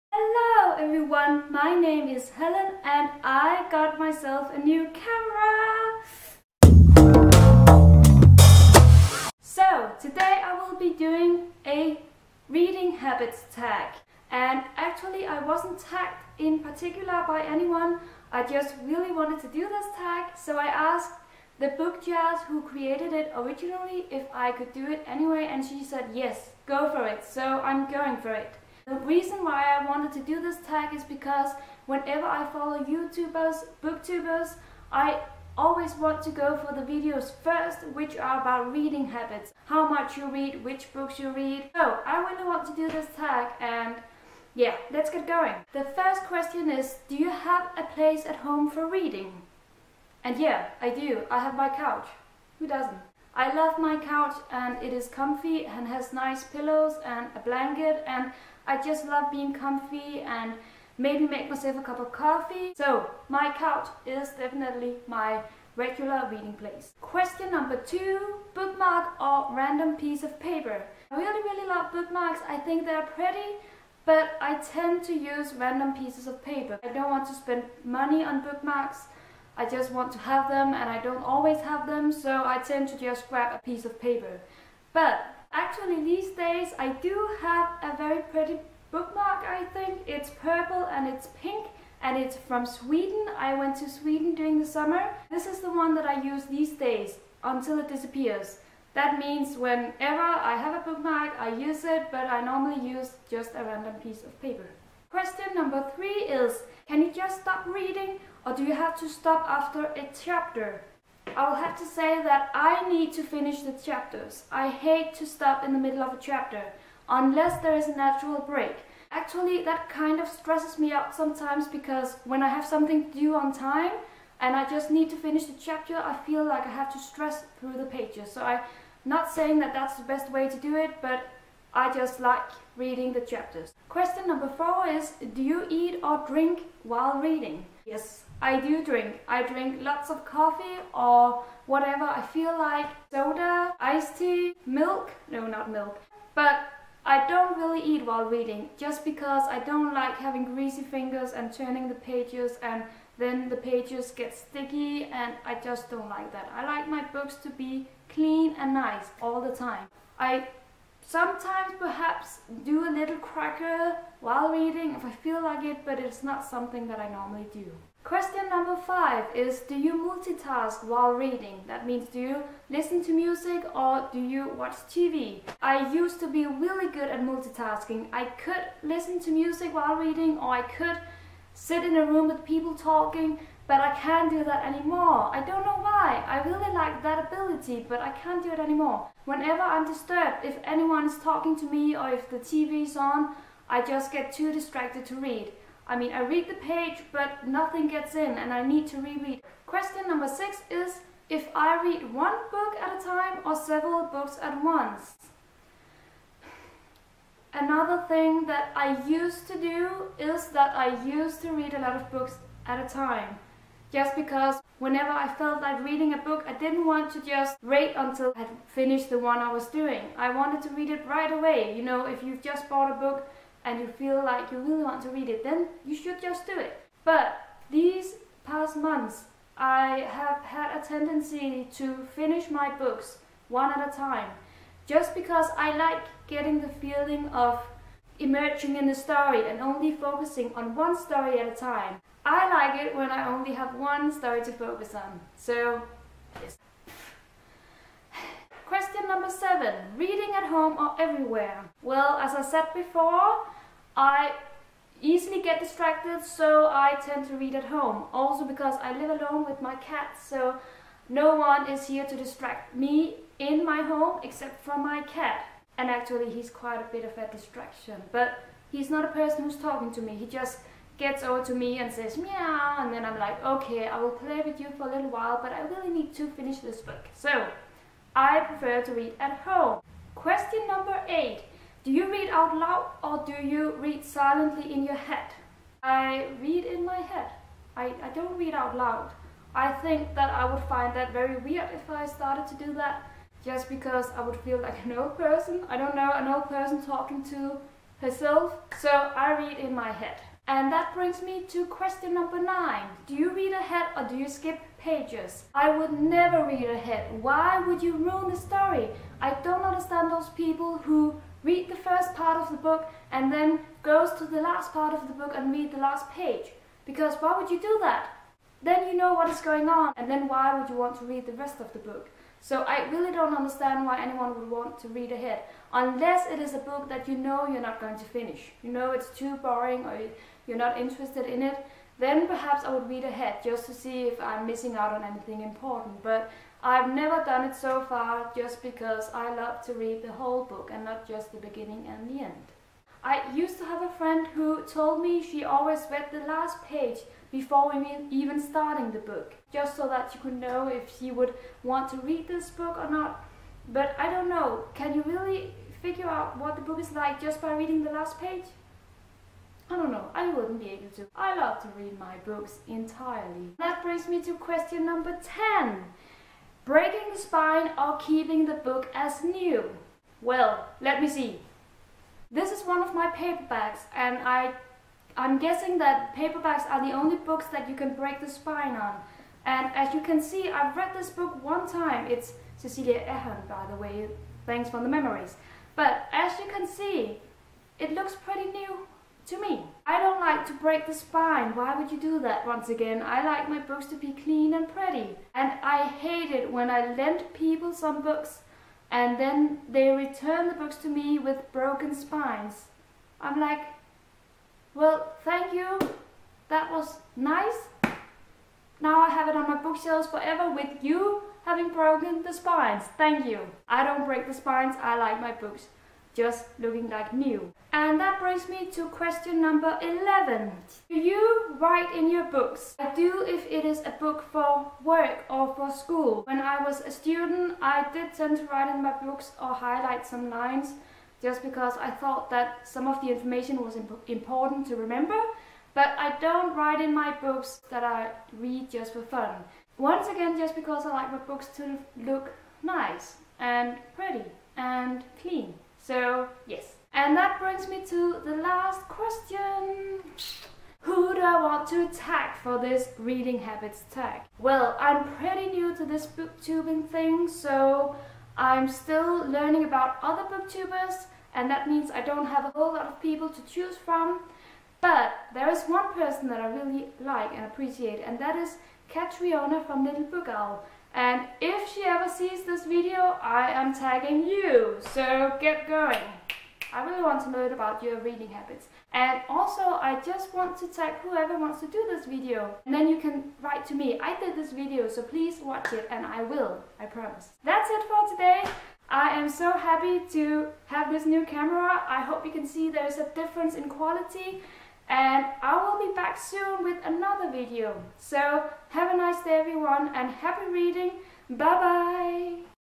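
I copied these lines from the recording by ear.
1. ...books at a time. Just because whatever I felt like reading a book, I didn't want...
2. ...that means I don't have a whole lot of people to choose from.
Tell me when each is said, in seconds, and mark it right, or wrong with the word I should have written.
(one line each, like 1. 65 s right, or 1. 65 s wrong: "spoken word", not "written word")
1. 212 s wrong: "whenever", not "whatever"
2. 461 s right.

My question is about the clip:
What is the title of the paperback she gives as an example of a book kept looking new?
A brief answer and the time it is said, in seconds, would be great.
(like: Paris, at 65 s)
Thanks for the Memories, at 384 s.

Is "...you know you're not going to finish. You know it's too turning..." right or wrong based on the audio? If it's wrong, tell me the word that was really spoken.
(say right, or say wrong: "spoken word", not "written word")
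wrong: "boring", not "turning".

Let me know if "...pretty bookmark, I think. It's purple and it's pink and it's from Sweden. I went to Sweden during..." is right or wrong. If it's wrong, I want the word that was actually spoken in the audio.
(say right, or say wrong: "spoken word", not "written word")
right.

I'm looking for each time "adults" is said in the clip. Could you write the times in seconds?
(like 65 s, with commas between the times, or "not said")
not said.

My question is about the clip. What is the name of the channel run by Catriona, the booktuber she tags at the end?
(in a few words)
Little Book Owl.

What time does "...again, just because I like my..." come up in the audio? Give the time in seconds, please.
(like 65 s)
440 s.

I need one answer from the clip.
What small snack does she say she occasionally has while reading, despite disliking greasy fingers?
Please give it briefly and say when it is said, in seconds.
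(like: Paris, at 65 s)
Cracker, at 163 s.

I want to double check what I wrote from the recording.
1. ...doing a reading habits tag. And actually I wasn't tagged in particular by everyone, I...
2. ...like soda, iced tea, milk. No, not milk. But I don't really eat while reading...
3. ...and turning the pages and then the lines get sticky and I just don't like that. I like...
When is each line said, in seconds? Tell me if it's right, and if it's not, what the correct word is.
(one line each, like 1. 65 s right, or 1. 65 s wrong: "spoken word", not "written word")
1. 10 s wrong: "anyone", not "everyone"
2. 142 s right
3. 151 s wrong: "pages", not "lines".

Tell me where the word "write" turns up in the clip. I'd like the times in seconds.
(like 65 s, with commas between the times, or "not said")
421 s, 428 s, 436 s, 483 s.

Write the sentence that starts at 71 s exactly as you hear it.
I really really love bookmarks, I think they're pretty, but I tend to use random pieces of paper.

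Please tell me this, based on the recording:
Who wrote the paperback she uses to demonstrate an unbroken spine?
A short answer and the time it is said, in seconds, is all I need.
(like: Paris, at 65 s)
Cecelia Ahern, at 382 s.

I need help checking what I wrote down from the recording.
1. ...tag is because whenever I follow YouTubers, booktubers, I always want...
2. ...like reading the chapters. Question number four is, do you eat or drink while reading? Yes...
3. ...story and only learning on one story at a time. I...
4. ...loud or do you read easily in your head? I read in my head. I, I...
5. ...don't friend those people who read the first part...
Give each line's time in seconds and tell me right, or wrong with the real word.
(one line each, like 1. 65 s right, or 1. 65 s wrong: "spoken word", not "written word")
1. 30 s right
2. 132 s right
3. 238 s wrong: "focusing", not "learning"
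4. 282 s wrong: "silently", not "easily"
5. 309 s wrong: "understand", not "friend".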